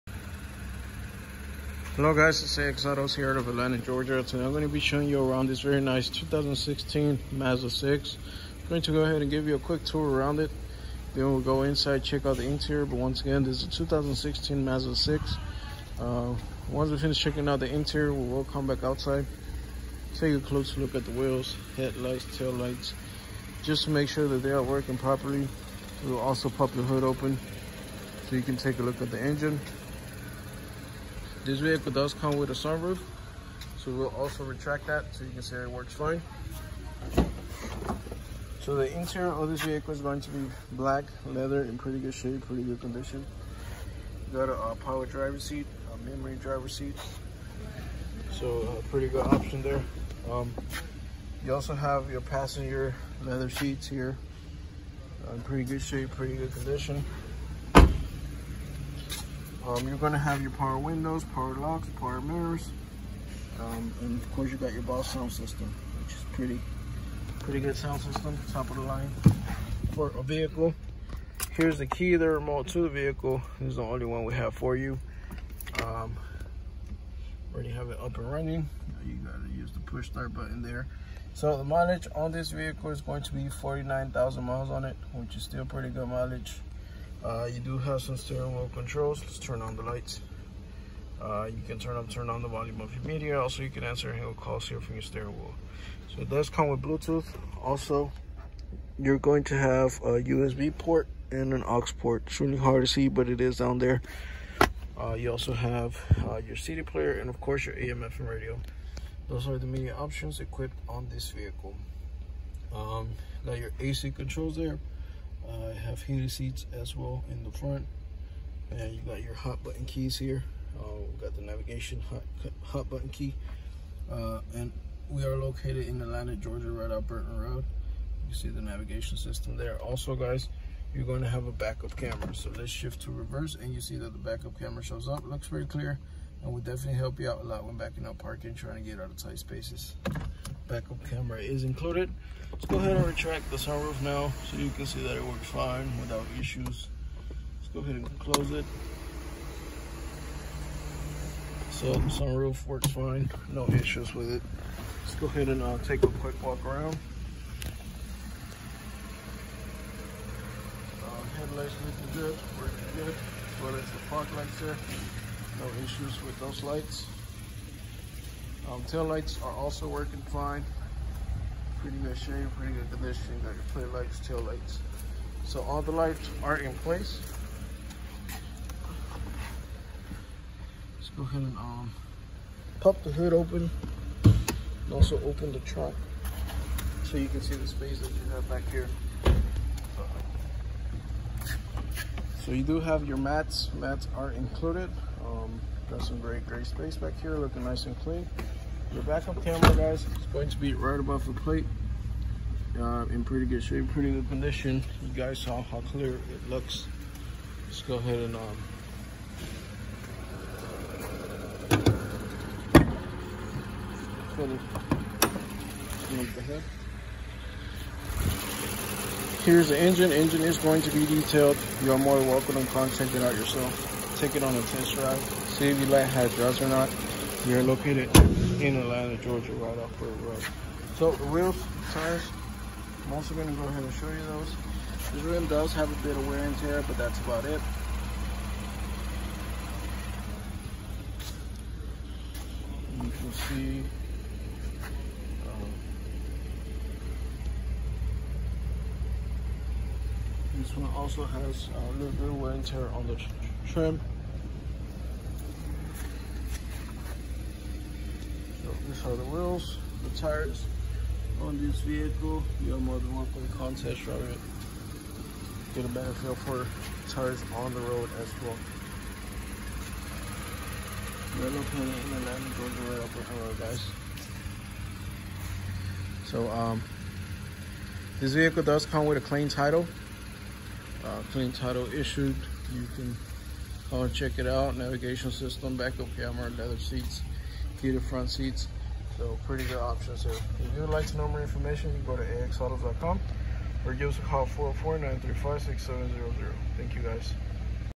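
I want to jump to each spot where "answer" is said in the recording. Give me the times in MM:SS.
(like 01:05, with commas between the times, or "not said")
01:33.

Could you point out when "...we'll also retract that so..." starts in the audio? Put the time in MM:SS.
00:33.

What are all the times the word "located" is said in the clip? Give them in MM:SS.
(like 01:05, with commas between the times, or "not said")
02:05, 03:47.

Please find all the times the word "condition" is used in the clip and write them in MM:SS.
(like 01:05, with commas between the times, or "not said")
00:42, 00:56, 02:52, 03:24.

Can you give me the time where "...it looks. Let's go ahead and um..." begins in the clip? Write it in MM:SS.
03:26.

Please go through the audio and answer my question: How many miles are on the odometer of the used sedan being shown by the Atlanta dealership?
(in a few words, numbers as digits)
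49,000 miles.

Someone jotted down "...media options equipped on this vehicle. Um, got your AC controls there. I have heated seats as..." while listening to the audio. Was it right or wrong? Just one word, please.
right.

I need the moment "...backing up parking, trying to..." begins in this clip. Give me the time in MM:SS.
02:17.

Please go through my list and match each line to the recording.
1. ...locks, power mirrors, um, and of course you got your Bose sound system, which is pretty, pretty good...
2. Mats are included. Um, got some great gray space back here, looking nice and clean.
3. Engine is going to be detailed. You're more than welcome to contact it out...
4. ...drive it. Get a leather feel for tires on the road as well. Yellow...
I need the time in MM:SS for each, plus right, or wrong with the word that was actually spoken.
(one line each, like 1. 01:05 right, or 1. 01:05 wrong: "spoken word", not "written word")
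1. 01:01 right
2. 03:13 right
3. 03:40 right
4. 04:24 wrong: "better", not "leather".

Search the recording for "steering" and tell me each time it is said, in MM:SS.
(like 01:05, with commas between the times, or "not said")
01:28, 01:35.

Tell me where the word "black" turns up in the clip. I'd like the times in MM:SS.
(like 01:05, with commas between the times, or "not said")
00:40.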